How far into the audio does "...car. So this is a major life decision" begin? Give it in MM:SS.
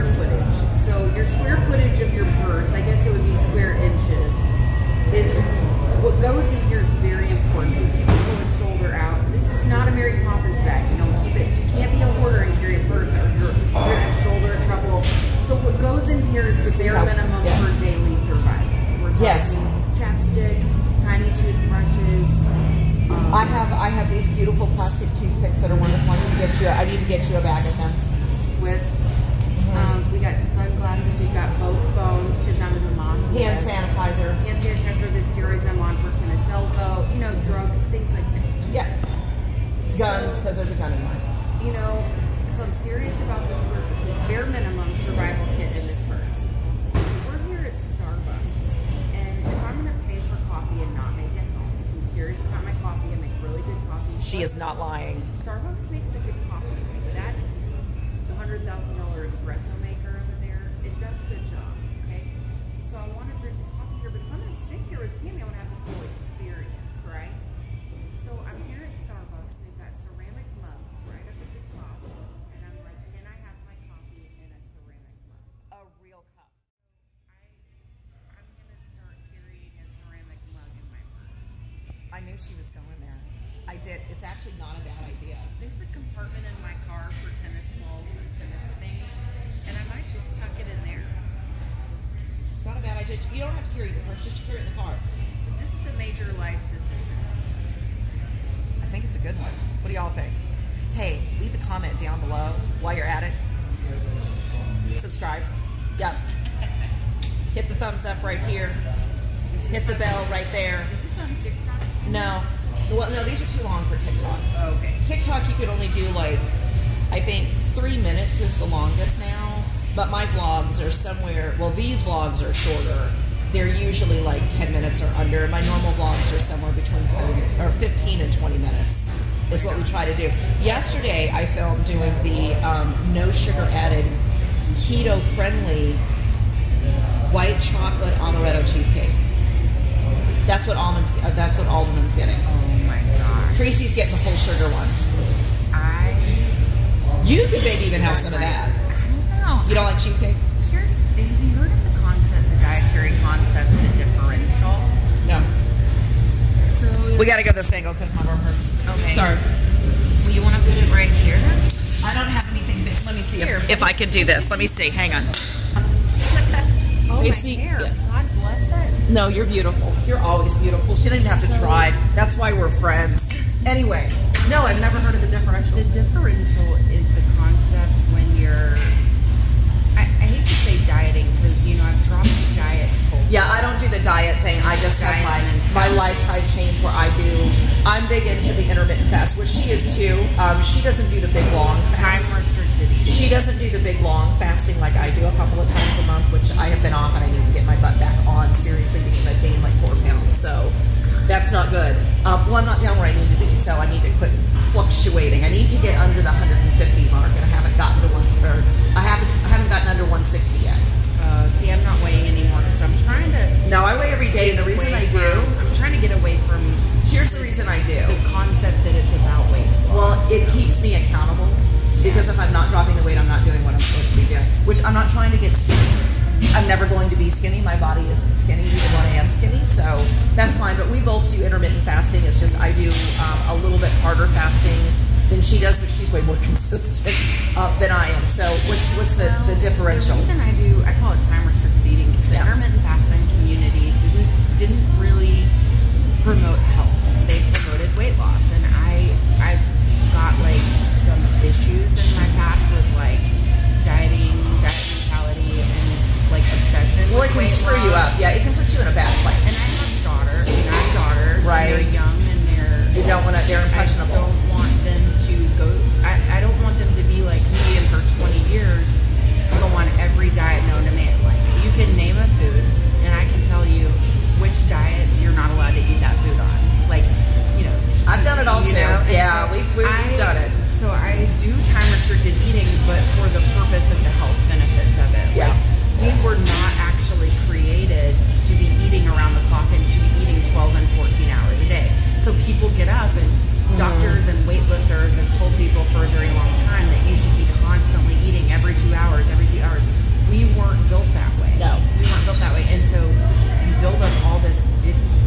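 01:34.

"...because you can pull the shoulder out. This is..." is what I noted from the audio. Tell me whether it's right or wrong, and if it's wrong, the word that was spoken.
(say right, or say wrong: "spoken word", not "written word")
right.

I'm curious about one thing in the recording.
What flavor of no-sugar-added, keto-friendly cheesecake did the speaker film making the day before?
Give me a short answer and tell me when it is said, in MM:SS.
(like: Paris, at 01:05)
white chocolate amaretto, at 02:17.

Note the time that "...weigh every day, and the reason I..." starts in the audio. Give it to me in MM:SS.
03:33.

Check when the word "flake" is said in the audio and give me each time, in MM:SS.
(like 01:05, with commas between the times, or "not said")
not said.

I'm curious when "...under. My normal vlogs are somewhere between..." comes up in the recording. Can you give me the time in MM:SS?
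02:05.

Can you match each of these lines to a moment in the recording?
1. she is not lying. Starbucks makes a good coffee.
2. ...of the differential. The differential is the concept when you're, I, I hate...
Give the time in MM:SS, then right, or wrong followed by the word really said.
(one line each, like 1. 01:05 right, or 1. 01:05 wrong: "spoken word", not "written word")
1. 00:54 right
2. 02:55 right.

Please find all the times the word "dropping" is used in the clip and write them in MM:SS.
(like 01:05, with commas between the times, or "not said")
03:42.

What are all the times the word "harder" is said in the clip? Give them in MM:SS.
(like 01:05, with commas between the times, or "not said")
03:54.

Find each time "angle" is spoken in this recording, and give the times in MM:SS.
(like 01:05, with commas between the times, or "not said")
02:37.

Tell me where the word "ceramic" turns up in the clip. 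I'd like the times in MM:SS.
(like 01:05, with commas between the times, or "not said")
01:10, 01:14, 01:20.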